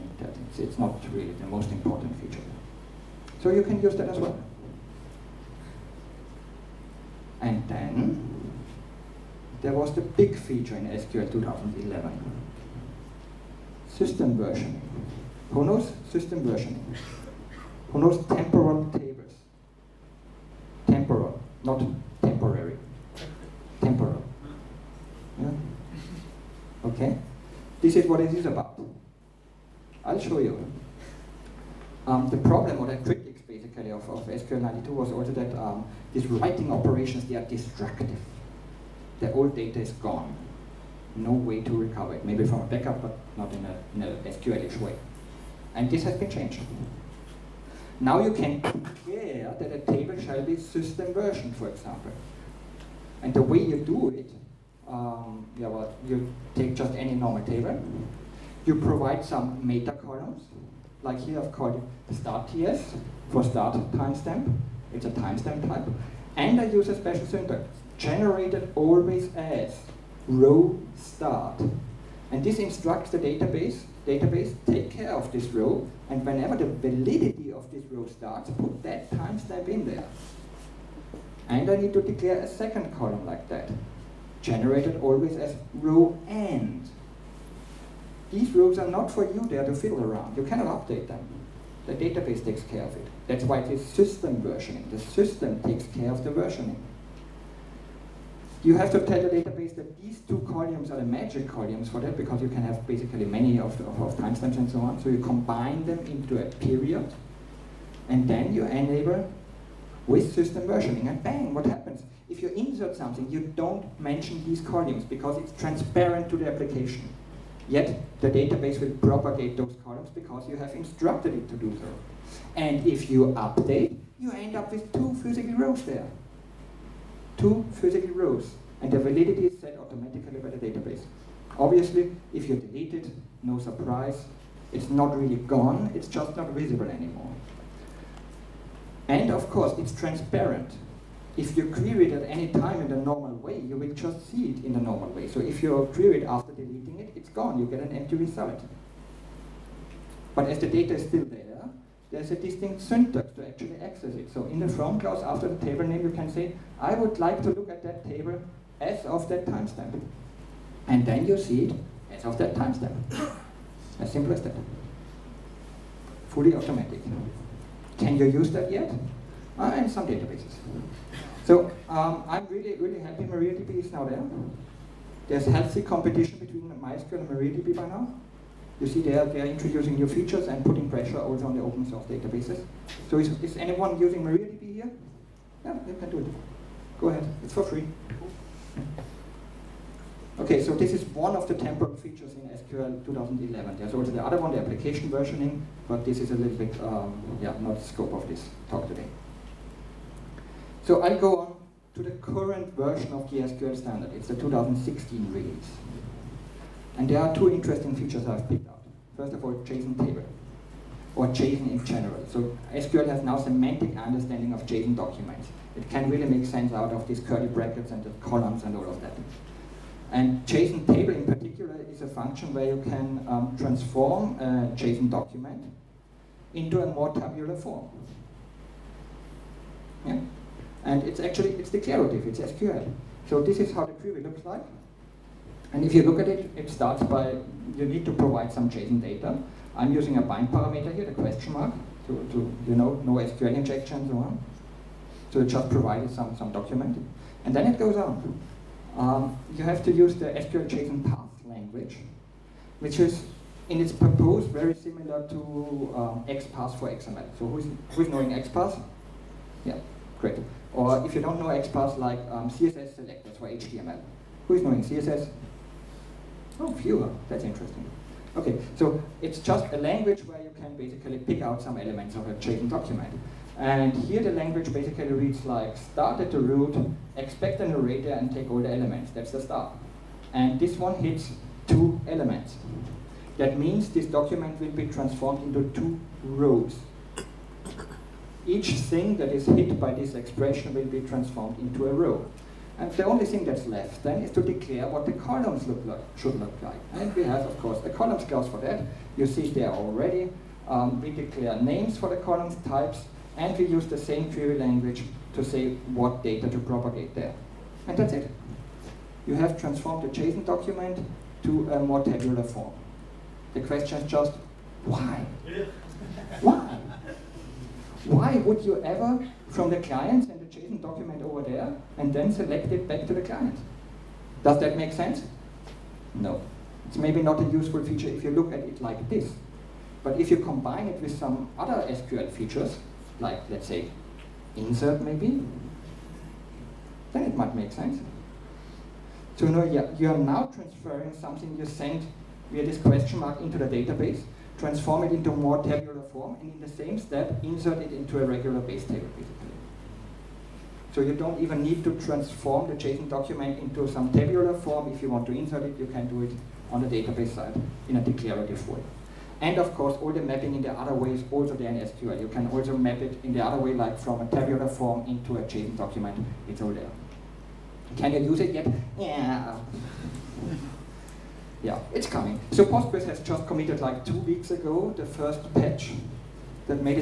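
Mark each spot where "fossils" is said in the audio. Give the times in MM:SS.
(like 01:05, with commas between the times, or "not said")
not said.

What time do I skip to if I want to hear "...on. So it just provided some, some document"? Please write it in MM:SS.
04:04.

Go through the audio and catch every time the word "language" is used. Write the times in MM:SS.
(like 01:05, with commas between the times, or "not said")
04:11, 04:29, 04:34, 05:04.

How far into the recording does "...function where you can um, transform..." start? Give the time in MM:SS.
03:42.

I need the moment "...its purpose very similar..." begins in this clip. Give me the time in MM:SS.
04:13.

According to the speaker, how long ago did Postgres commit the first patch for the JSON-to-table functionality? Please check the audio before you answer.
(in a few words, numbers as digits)
two weeks ago.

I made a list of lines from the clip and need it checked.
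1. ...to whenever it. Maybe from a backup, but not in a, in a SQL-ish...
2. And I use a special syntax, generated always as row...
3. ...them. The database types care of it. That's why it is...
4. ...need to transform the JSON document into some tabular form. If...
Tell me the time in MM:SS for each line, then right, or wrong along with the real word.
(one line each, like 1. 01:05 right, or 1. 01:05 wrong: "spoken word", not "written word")
1. 00:41 wrong: "recover", not "whenever"
2. 01:06 right
3. 01:31 wrong: "takes", not "types"
4. 05:51 right.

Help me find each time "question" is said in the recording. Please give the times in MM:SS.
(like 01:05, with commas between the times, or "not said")
04:01, 05:13, 05:42.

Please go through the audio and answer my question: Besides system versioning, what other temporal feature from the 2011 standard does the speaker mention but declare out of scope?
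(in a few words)
application versioning.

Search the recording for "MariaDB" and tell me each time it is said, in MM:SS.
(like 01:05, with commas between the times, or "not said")
02:53, 02:57, 03:04.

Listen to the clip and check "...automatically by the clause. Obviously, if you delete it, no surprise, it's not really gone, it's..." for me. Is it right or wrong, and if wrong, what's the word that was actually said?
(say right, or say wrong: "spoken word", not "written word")
wrong: "database", not "clause".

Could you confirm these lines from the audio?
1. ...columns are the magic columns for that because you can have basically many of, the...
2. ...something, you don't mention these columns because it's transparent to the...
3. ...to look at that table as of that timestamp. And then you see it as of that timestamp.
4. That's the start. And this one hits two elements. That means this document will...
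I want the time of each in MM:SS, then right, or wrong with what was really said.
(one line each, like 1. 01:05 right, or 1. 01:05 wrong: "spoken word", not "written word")
1. 01:40 right
2. 01:52 right
3. 02:37 right
4. 04:39 right.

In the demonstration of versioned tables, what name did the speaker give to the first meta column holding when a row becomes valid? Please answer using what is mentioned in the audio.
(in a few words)
start TS.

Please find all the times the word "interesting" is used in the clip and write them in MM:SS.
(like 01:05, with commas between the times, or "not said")
03:27, 04:27.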